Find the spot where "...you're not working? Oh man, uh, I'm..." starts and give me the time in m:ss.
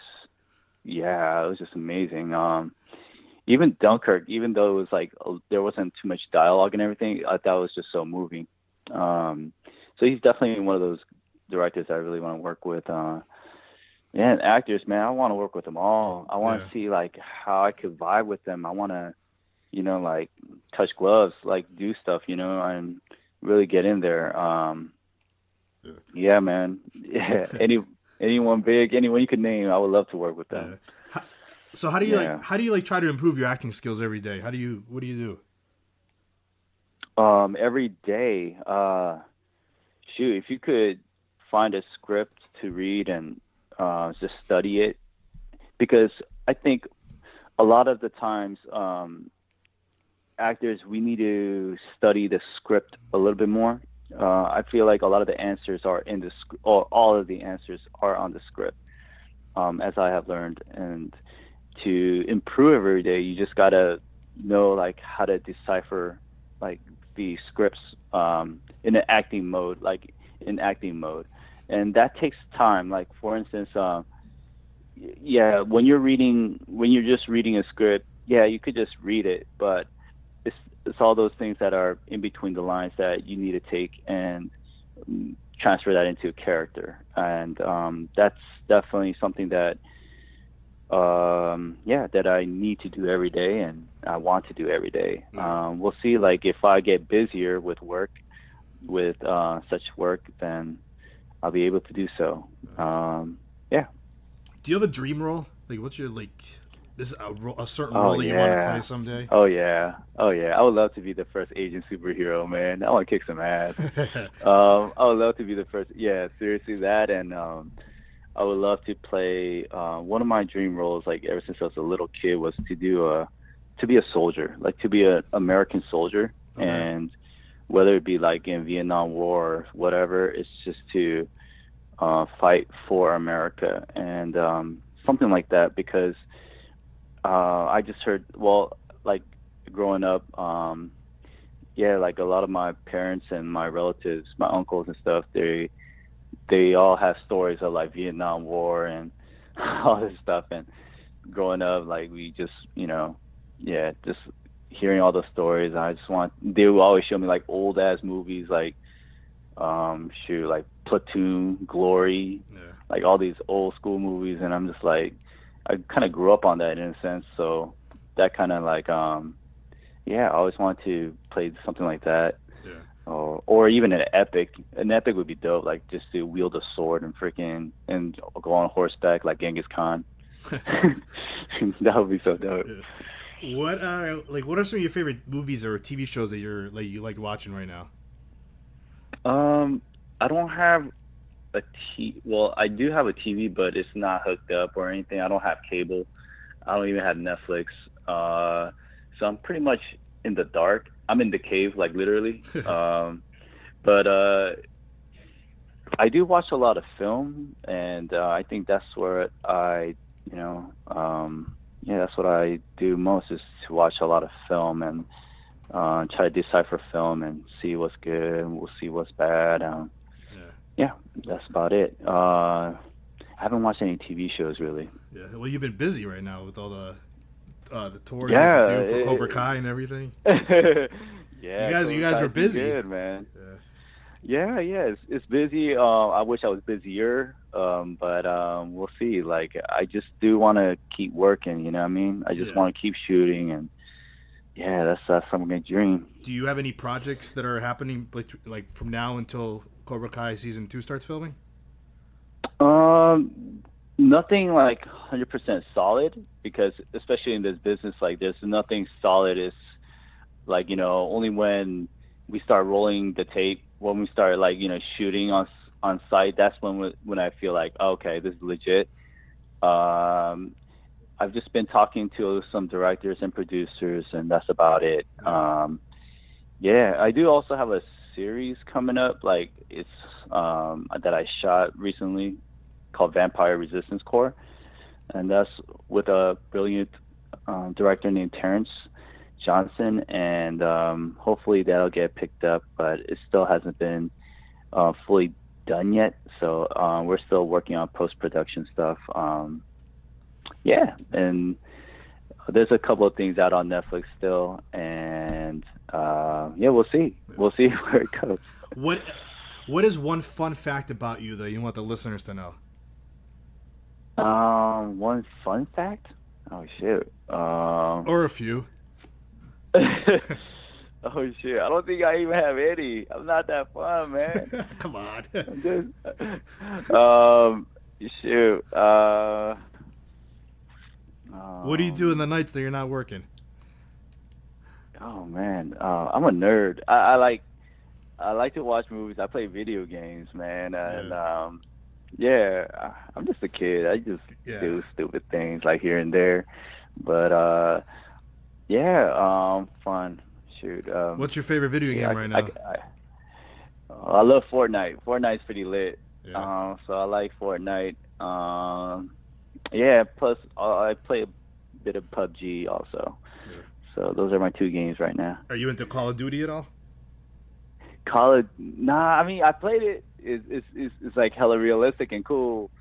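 5:32.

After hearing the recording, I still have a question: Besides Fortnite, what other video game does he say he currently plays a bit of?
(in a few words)
PUBG.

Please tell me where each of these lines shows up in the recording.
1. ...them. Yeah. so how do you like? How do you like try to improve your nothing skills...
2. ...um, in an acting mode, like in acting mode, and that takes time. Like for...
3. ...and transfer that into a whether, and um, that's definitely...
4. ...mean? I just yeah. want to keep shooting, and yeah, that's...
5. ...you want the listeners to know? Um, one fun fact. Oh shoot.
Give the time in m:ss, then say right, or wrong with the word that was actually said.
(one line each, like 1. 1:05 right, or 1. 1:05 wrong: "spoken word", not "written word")
1. 0:30 wrong: "acting", not "nothing"
2. 1:08 right
3. 1:24 wrong: "character", not "whether"
4. 4:01 right
5. 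5:11 right.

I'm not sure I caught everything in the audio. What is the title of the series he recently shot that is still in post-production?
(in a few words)
Vampire Resistance Corps.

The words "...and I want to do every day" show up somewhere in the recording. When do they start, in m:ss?
1:33.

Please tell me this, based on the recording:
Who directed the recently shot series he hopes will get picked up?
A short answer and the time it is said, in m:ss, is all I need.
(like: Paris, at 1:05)
Terrence Johnson, at 4:48.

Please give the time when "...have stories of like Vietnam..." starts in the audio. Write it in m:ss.
2:26.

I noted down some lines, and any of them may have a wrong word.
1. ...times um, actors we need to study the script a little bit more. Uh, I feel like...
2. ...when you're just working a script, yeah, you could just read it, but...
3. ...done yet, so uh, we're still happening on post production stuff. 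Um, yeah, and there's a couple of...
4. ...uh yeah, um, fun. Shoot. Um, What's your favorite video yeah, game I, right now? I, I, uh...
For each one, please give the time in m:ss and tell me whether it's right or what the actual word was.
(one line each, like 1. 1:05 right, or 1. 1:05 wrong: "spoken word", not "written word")
1. 0:48 right
2. 1:16 wrong: "reading", not "working"
3. 4:55 wrong: "working", not "happening"
4. 5:47 right.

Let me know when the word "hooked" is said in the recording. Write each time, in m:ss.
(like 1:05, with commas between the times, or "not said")
3:14.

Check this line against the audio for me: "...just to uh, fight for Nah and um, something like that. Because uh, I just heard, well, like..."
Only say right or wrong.
wrong.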